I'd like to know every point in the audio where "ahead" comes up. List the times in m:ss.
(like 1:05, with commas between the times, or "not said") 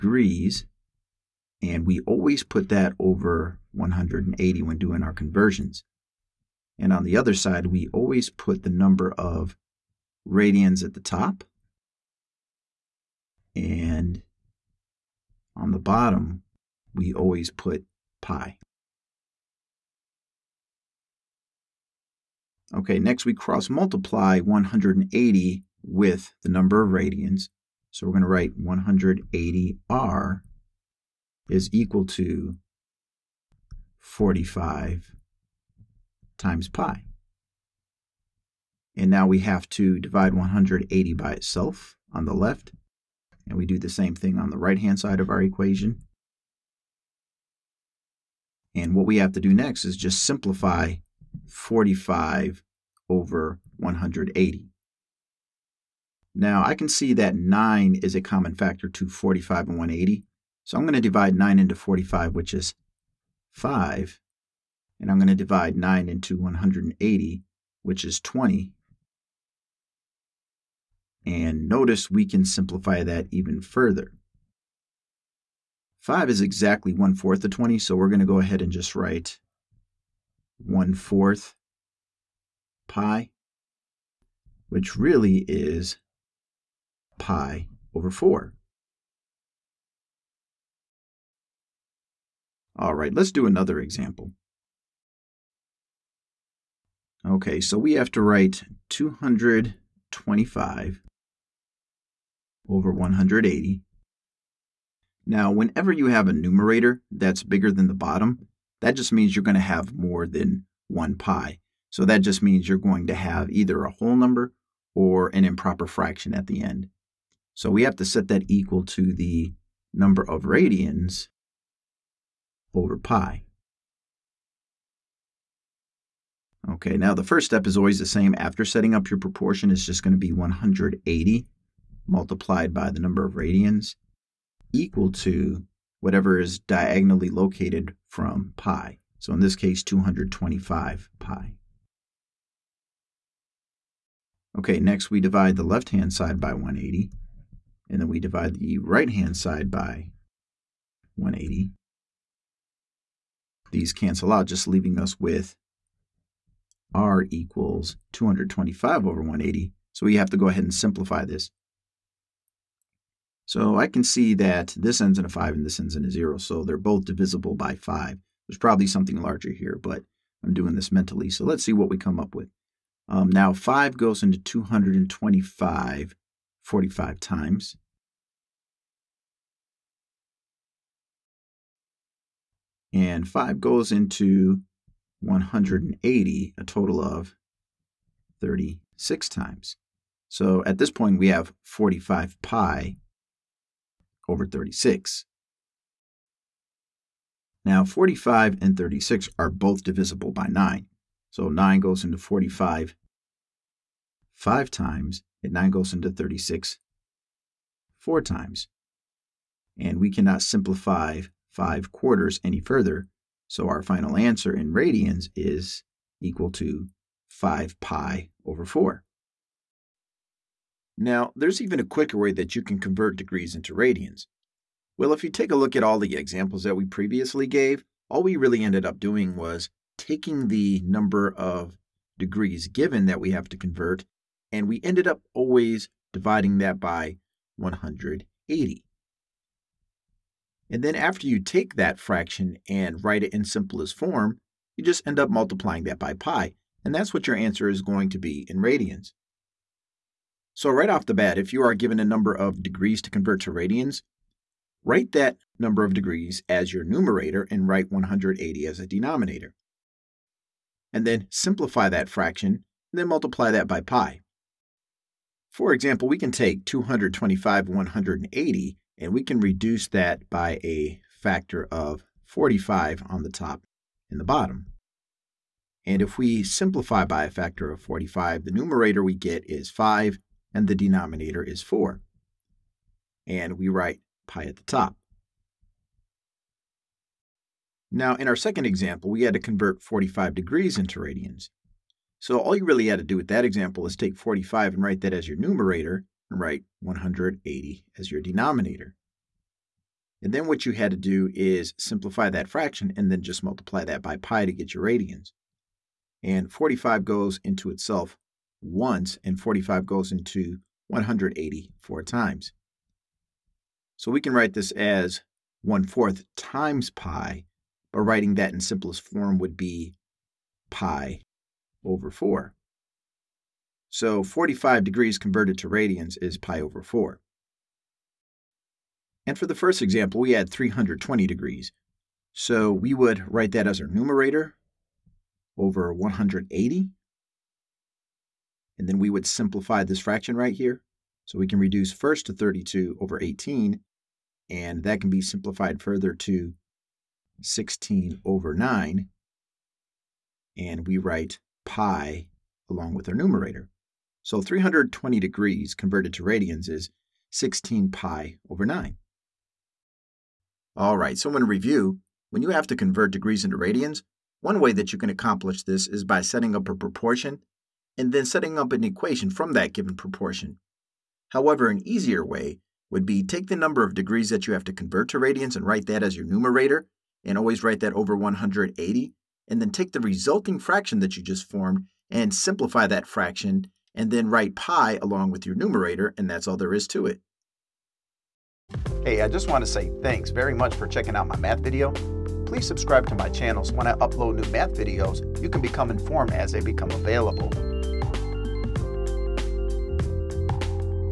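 1:18, 2:40.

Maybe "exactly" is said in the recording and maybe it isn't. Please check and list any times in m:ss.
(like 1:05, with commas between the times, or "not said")
1:16.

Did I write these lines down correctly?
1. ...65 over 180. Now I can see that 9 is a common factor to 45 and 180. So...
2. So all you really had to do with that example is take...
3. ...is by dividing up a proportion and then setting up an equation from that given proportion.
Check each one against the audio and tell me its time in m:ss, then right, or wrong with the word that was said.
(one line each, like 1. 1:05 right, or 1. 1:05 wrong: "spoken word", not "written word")
1. 0:51 wrong: "45", not "65"
2. 4:52 right
3. 6:05 wrong: "setting", not "dividing".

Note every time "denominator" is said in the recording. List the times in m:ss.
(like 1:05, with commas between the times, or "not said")
4:18, 4:40, 4:58.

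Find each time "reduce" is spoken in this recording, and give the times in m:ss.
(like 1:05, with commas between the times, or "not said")
4:29, 5:41.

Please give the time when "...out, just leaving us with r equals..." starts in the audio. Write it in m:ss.
2:34.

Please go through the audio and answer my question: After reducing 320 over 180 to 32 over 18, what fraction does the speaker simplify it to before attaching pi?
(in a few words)
16 over 9.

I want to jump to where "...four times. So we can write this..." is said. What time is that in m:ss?
5:11.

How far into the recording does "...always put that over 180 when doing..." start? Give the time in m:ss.
0:02.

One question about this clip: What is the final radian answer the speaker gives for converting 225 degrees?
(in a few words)
5 pi over 4.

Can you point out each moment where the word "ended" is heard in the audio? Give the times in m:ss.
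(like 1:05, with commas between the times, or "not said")
3:48, 3:54.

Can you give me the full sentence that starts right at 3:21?
So 9 goes into 45 5 times, and 9 goes into 36 4 times.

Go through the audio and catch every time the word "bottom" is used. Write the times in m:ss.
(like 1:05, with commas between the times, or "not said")
0:15, 1:47, 4:34.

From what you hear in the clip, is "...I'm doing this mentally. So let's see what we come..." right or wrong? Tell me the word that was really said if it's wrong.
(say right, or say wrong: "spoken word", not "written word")
right.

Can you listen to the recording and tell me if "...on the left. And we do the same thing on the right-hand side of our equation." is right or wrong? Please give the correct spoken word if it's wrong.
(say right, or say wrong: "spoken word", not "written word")
right.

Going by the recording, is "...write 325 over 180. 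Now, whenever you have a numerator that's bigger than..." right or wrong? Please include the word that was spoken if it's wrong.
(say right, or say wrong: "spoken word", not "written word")
wrong: "225", not "325".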